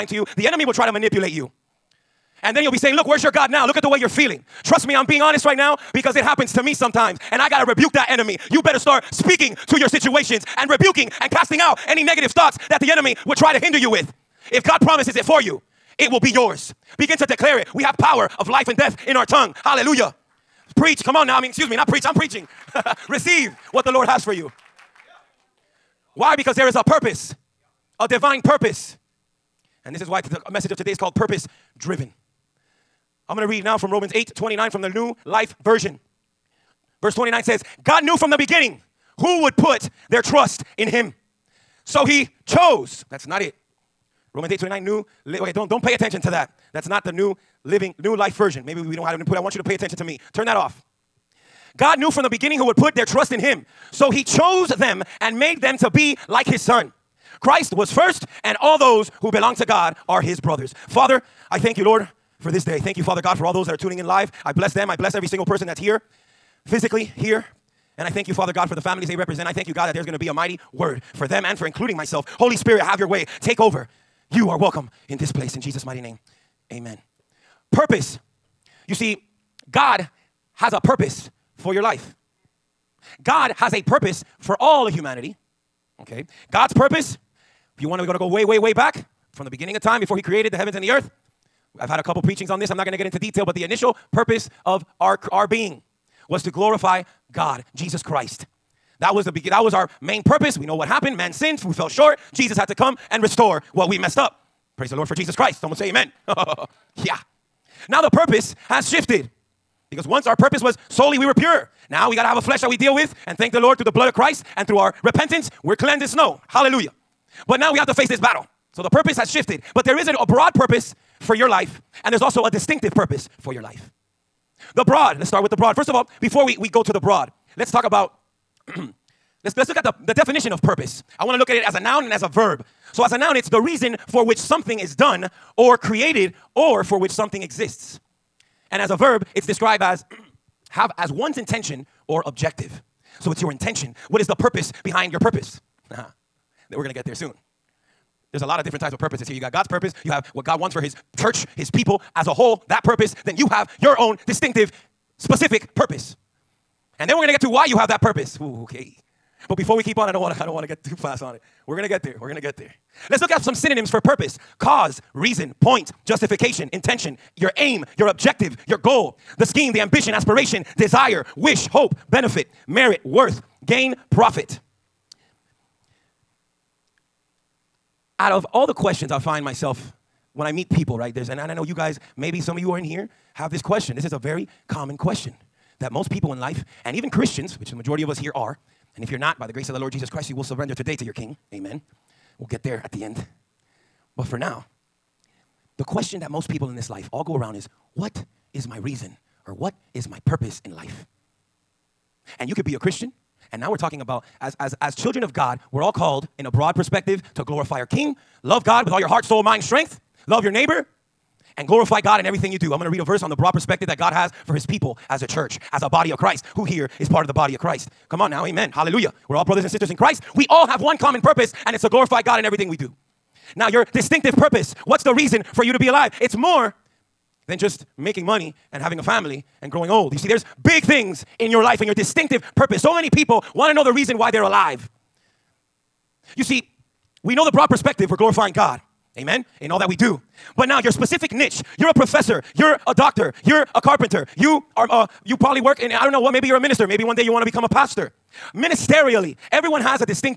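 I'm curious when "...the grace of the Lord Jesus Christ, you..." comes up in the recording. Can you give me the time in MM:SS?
03:09.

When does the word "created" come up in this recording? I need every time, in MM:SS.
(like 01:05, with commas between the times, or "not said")
01:30, 02:15.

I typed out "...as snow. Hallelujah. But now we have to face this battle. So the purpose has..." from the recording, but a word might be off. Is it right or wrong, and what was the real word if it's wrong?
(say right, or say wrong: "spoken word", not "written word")
right.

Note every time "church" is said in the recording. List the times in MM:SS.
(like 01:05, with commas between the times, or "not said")
02:31, 03:35.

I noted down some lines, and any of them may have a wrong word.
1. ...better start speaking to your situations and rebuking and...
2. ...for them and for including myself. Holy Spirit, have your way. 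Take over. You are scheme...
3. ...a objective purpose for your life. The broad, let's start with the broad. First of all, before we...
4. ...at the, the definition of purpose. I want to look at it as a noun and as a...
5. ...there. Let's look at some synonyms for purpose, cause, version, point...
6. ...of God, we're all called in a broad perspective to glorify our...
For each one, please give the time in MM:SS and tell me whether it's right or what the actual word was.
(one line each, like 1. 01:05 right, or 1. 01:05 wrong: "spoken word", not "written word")
1. 00:08 right
2. 01:11 wrong: "welcome", not "scheme"
3. 02:02 wrong: "distinctive", not "objective"
4. 02:09 right
5. 02:42 wrong: "reason", not "version"
6. 03:25 right.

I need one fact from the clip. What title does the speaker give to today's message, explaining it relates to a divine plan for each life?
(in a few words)
Purpose Driven.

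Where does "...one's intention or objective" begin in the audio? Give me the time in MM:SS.
02:21.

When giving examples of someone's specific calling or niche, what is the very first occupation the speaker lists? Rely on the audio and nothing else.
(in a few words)
Professor.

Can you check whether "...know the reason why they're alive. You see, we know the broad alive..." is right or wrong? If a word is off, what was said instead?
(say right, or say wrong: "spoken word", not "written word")
wrong: "perspective", not "alive".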